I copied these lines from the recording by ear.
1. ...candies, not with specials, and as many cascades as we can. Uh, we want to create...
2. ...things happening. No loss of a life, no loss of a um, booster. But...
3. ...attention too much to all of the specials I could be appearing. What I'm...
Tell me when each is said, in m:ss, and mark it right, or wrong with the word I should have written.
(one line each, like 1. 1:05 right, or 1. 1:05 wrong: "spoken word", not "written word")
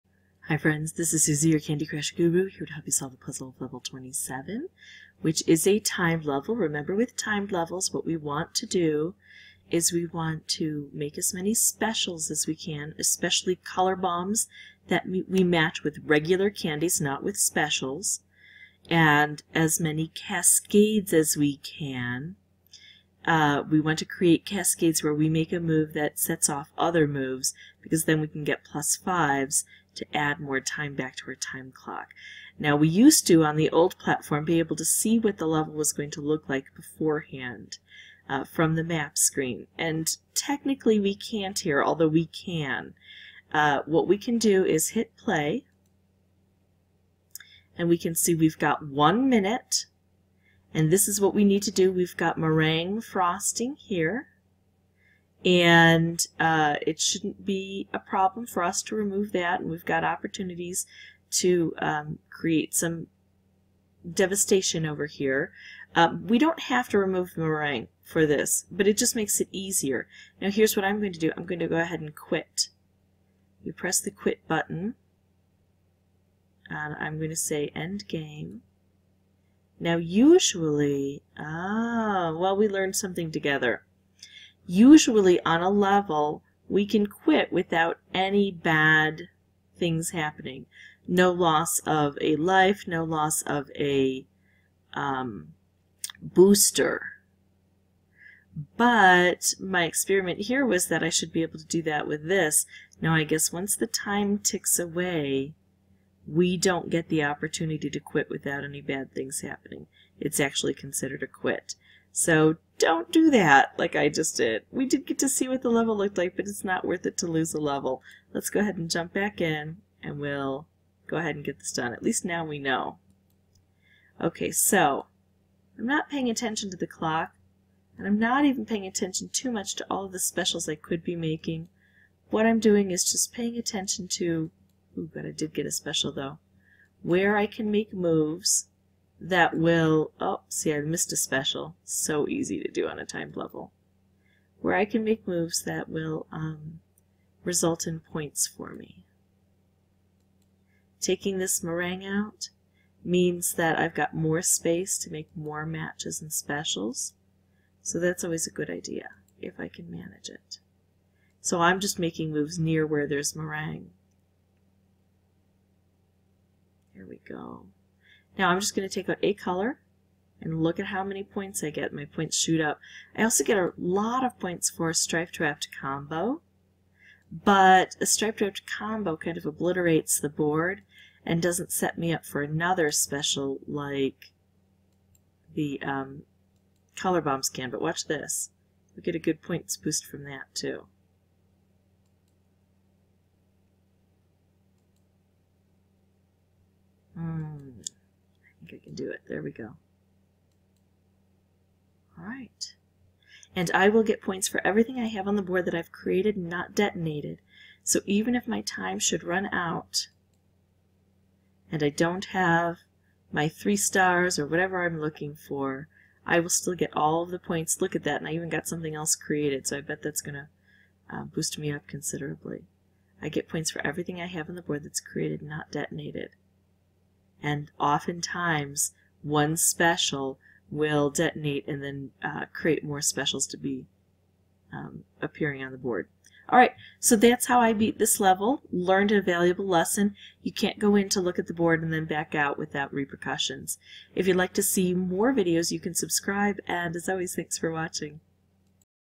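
1. 0:16 right
2. 1:29 right
3. 2:08 wrong: "making", not "appearing".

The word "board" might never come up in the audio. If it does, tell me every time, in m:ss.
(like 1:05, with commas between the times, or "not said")
3:00, 3:25, 3:44, 3:55, 4:01.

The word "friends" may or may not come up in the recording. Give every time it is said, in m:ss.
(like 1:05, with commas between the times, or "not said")
0:00.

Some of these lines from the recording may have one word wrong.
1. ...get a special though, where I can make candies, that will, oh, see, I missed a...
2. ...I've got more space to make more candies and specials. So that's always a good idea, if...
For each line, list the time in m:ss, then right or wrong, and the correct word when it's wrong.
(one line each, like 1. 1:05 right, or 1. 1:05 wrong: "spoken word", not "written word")
1. 2:15 wrong: "moves", not "candies"
2. 2:33 wrong: "matches", not "candies".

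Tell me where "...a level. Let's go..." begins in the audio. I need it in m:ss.
1:57.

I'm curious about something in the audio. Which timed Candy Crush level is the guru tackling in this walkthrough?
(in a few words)
27.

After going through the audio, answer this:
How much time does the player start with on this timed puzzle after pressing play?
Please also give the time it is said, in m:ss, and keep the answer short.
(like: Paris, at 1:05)
1 minute, at 0:48.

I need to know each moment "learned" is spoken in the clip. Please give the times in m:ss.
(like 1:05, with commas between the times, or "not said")
1:22, 3:58.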